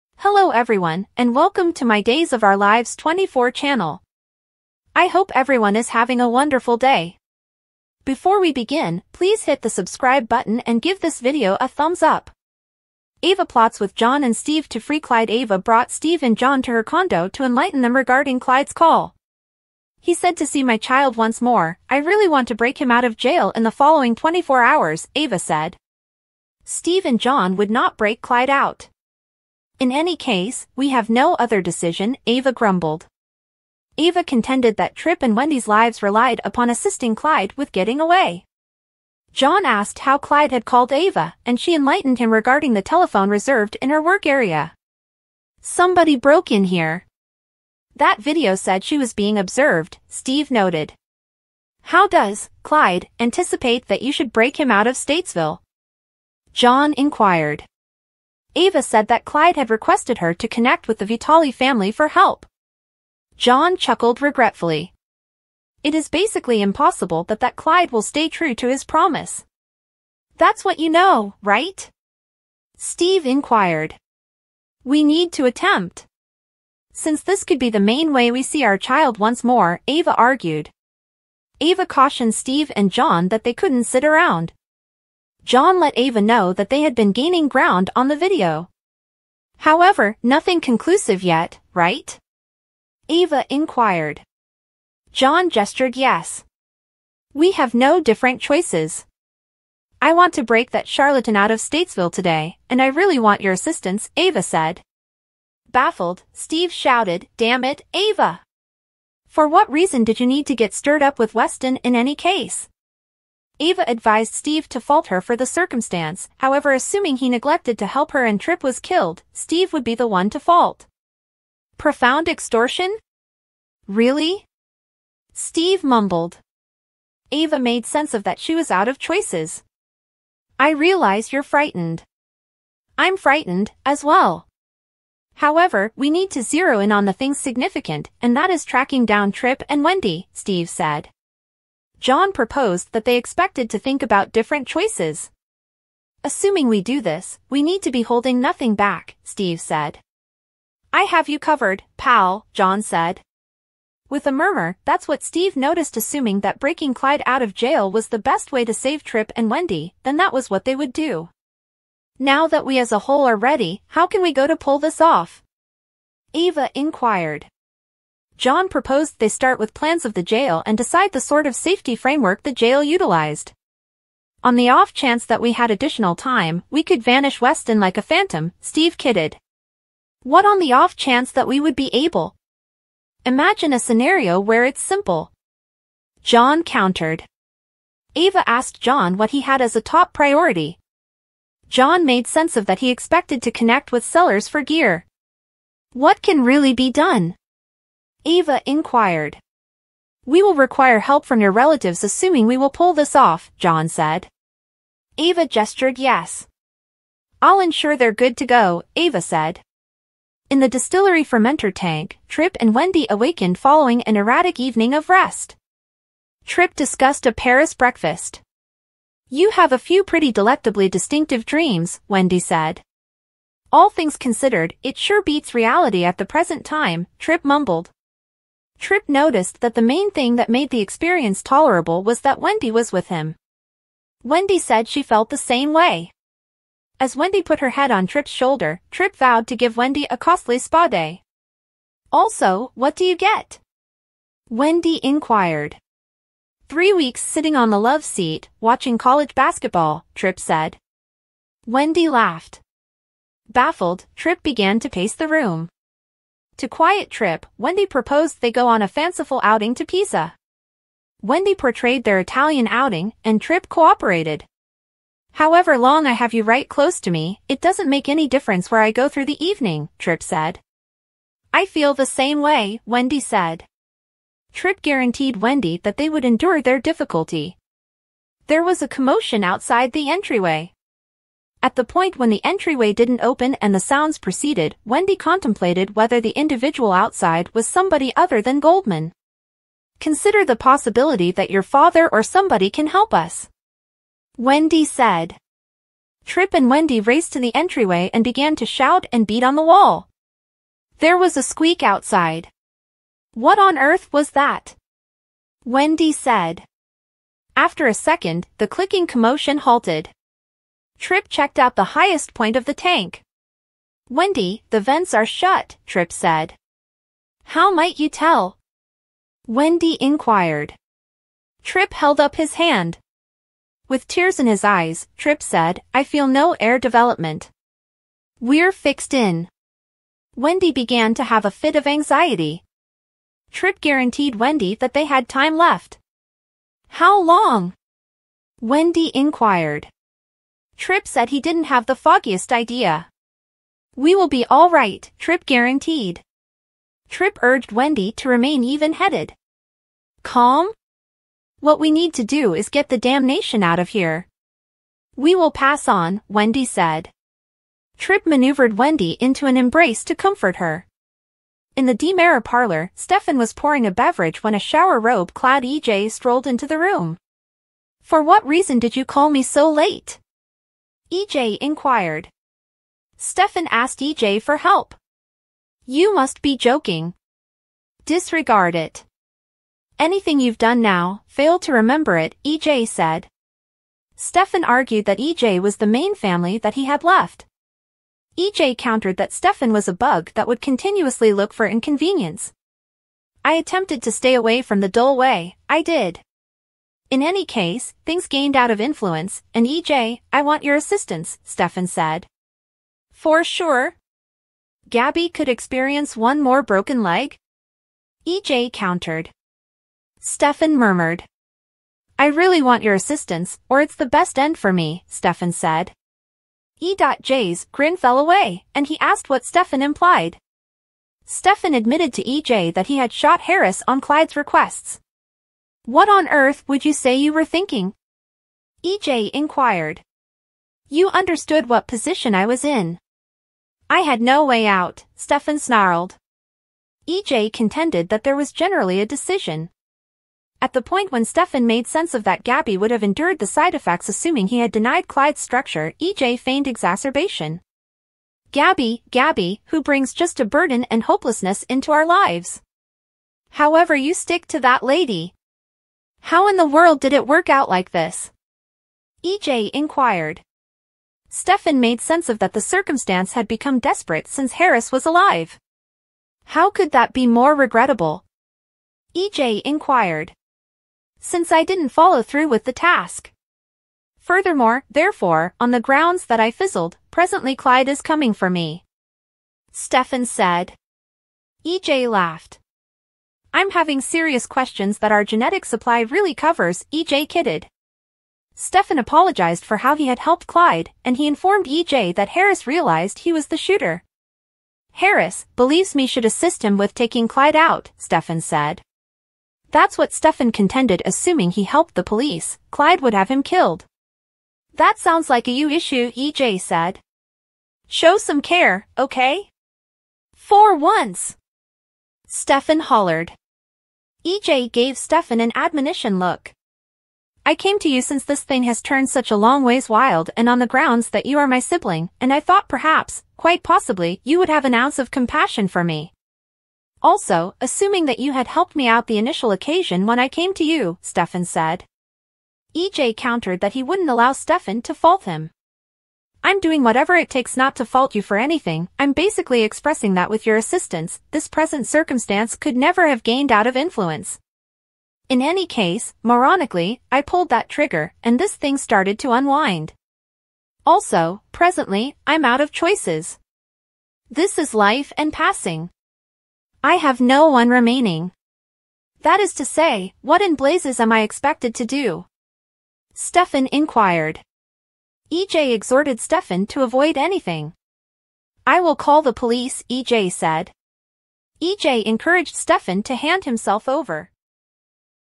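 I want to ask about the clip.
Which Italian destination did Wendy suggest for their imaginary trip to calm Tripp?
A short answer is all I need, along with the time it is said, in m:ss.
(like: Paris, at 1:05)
Pisa, at 4:19.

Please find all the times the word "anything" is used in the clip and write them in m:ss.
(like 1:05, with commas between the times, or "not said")
6:19, 8:58, 9:27.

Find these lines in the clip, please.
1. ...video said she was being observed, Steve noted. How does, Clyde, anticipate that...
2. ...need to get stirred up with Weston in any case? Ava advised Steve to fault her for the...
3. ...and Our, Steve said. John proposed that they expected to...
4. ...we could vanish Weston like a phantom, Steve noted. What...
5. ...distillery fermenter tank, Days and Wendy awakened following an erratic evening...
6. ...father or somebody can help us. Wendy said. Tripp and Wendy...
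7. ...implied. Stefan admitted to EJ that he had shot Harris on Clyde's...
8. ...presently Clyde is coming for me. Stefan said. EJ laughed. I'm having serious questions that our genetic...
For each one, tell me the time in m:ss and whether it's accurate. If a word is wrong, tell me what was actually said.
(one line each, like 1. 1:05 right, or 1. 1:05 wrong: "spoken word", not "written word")
1. 0:48 right
2. 1:50 right
3. 2:19 wrong: "Wendy", not "Our"
4. 2:56 wrong: "kidded", not "noted"
5. 3:30 wrong: "Tripp", not "Days"
6. 4:51 right
7. 6:59 right
8. 7:57 right.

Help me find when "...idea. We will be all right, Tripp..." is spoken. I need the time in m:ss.
5:42.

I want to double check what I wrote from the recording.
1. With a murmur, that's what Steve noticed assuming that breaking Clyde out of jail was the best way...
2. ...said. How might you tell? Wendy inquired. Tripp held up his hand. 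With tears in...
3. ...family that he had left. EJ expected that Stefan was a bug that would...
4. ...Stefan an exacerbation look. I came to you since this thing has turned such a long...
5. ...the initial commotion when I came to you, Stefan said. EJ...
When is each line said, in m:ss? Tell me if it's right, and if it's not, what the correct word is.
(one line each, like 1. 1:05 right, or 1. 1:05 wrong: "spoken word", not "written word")
1. 2:34 right
2. 5:16 right
3. 6:26 wrong: "countered", not "expected"
4. 8:34 wrong: "admonition", not "exacerbation"
5. 8:49 wrong: "occasion", not "commotion".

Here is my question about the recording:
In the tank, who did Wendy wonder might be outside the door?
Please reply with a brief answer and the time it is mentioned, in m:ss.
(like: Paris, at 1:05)
Somebody other than Goldman, at 4:48.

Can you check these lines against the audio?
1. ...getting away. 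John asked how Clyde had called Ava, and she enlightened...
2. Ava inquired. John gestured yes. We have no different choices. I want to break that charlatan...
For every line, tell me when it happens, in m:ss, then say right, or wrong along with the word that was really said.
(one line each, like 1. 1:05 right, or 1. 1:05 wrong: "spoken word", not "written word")
1. 0:37 right
2. 1:33 right.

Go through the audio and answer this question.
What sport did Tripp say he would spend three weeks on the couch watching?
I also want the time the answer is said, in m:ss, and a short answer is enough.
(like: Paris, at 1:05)
College basketball, at 4:08.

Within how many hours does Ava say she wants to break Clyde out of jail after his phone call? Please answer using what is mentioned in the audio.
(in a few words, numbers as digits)
24.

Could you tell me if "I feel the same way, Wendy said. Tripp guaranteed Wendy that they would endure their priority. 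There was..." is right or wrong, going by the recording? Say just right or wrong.
wrong.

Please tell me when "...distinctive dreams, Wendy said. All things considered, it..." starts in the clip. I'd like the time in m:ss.
3:40.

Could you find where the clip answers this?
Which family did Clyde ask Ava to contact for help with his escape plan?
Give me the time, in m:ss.
1:01.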